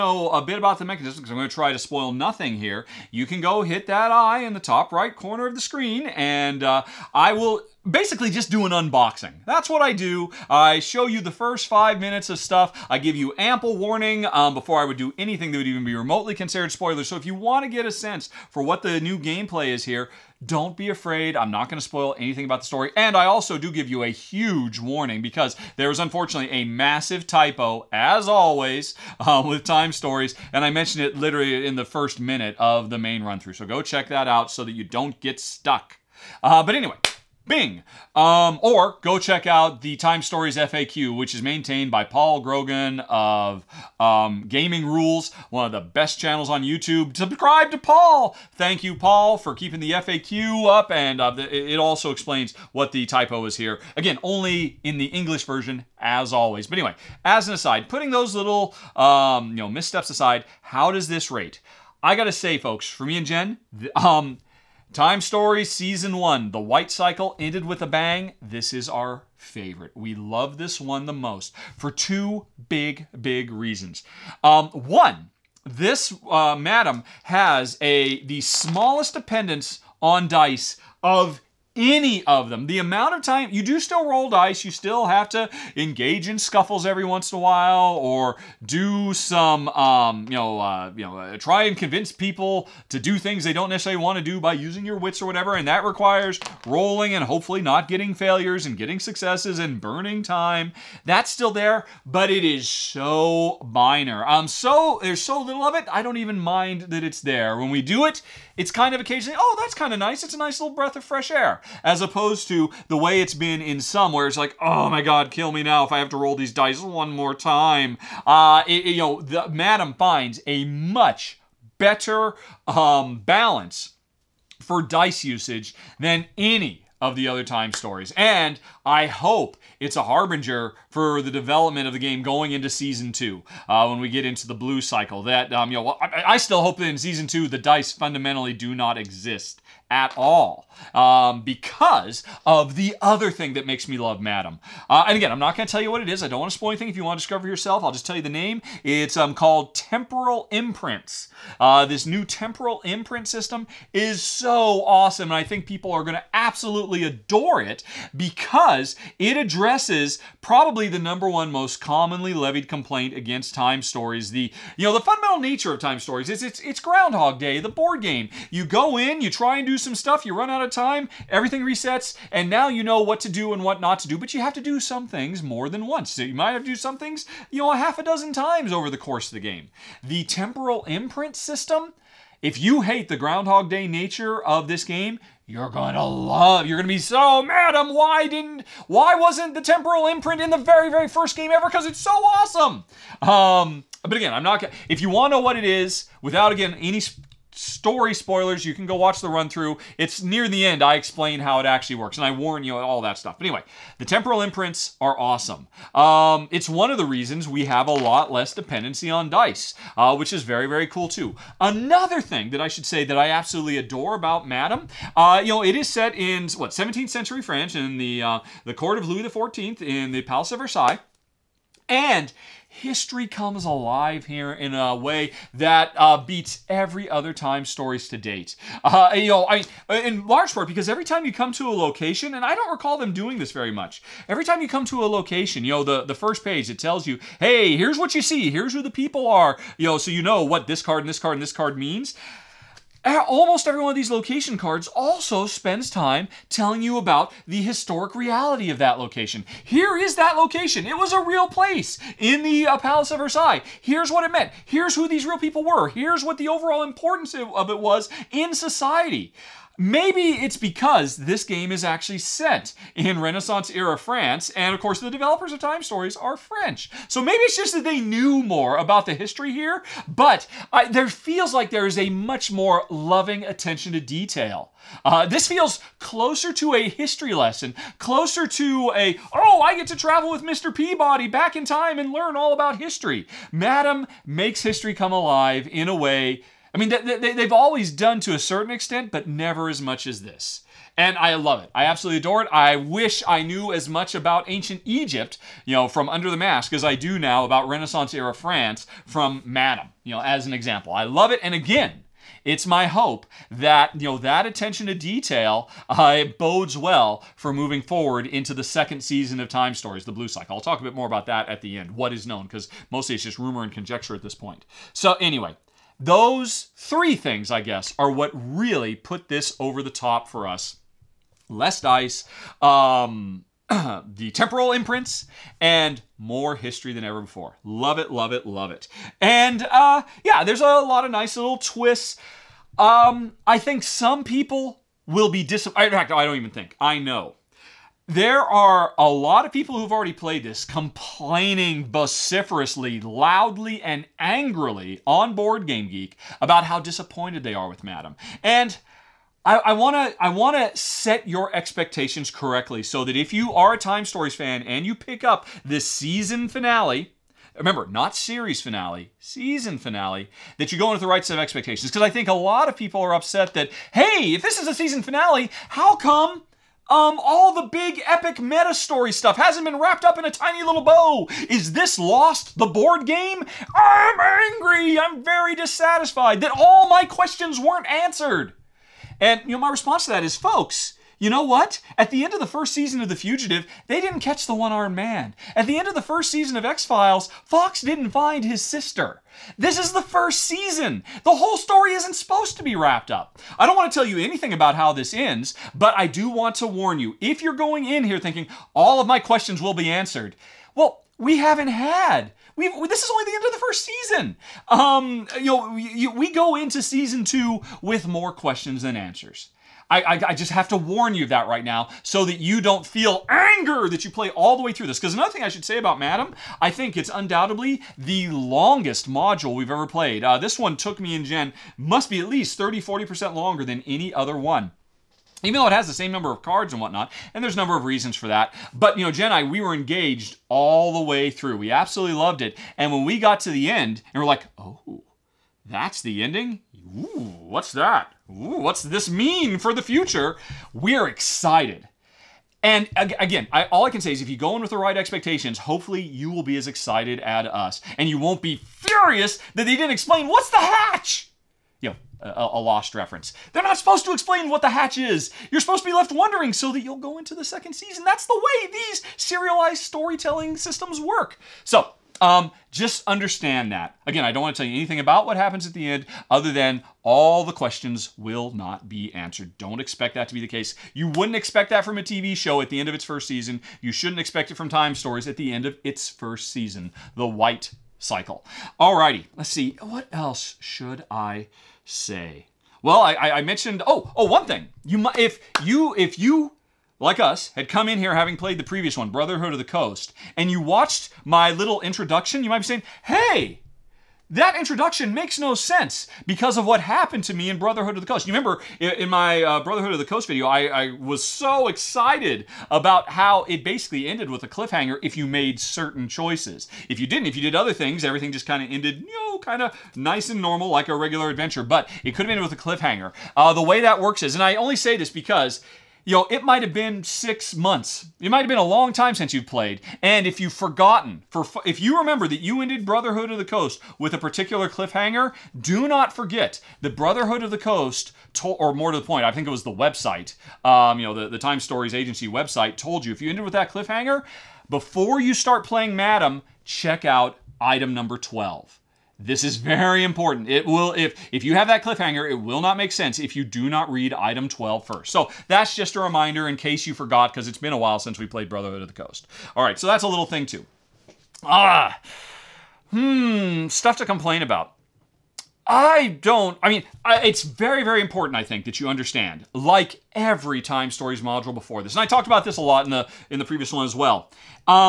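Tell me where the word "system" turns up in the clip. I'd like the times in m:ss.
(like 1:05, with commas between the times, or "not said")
2:33, 3:01, 7:40.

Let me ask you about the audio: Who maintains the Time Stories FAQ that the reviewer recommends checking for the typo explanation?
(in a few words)
Paul Grogan.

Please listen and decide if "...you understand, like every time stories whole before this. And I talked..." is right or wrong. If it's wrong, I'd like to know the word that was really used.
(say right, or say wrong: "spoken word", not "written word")
wrong: "module", not "whole".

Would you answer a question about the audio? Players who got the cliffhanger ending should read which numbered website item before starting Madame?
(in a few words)
Item 12.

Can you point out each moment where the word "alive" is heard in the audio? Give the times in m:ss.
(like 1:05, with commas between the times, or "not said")
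3:43, 4:45.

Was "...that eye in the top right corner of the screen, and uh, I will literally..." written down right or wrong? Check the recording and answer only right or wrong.
wrong.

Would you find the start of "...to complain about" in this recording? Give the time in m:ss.
9:13.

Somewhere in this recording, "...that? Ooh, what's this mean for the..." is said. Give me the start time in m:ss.
7:17.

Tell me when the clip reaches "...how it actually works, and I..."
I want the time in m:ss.
3:21.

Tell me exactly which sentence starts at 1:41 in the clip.
That's still there, but it is so minor.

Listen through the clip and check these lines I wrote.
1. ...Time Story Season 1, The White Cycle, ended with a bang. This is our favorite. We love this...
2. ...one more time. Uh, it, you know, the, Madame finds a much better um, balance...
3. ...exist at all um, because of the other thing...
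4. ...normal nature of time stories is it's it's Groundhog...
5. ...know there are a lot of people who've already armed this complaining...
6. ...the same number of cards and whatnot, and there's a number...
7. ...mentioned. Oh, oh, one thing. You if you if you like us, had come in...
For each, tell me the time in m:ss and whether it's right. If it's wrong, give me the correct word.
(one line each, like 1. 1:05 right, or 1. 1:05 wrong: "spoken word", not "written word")
1. 1:04 right
2. 1:56 right
3. 2:18 right
4. 2:44 wrong: "fundamental", not "normal"
5. 5:36 wrong: "played", not "armed"
6. 7:05 right
7. 8:03 right.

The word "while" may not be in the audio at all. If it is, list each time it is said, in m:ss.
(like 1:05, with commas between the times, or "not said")
1:27, 9:07.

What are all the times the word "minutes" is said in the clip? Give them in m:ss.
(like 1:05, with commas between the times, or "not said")
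0:11, 0:32.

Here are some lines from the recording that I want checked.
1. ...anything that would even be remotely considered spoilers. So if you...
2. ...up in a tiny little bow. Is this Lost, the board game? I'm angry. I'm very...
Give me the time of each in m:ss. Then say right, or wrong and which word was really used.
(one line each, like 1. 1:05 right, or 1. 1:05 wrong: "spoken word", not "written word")
1. 0:15 right
2. 6:10 right.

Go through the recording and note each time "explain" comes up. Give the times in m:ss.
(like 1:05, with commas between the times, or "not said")
0:52, 3:20, 7:29, 7:34.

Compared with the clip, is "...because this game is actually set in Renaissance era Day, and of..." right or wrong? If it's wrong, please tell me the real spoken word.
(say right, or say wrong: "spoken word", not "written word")
wrong: "France", not "Day".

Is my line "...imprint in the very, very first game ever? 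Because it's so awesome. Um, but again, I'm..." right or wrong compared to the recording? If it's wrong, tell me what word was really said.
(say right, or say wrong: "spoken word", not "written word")
right.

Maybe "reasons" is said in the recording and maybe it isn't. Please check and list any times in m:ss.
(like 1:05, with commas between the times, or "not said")
1:13, 3:27, 7:07.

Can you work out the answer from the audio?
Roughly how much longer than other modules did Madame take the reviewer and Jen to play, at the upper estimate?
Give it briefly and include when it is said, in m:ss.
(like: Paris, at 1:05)
40%, at 7:02.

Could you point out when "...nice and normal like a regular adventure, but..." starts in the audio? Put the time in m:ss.
8:29.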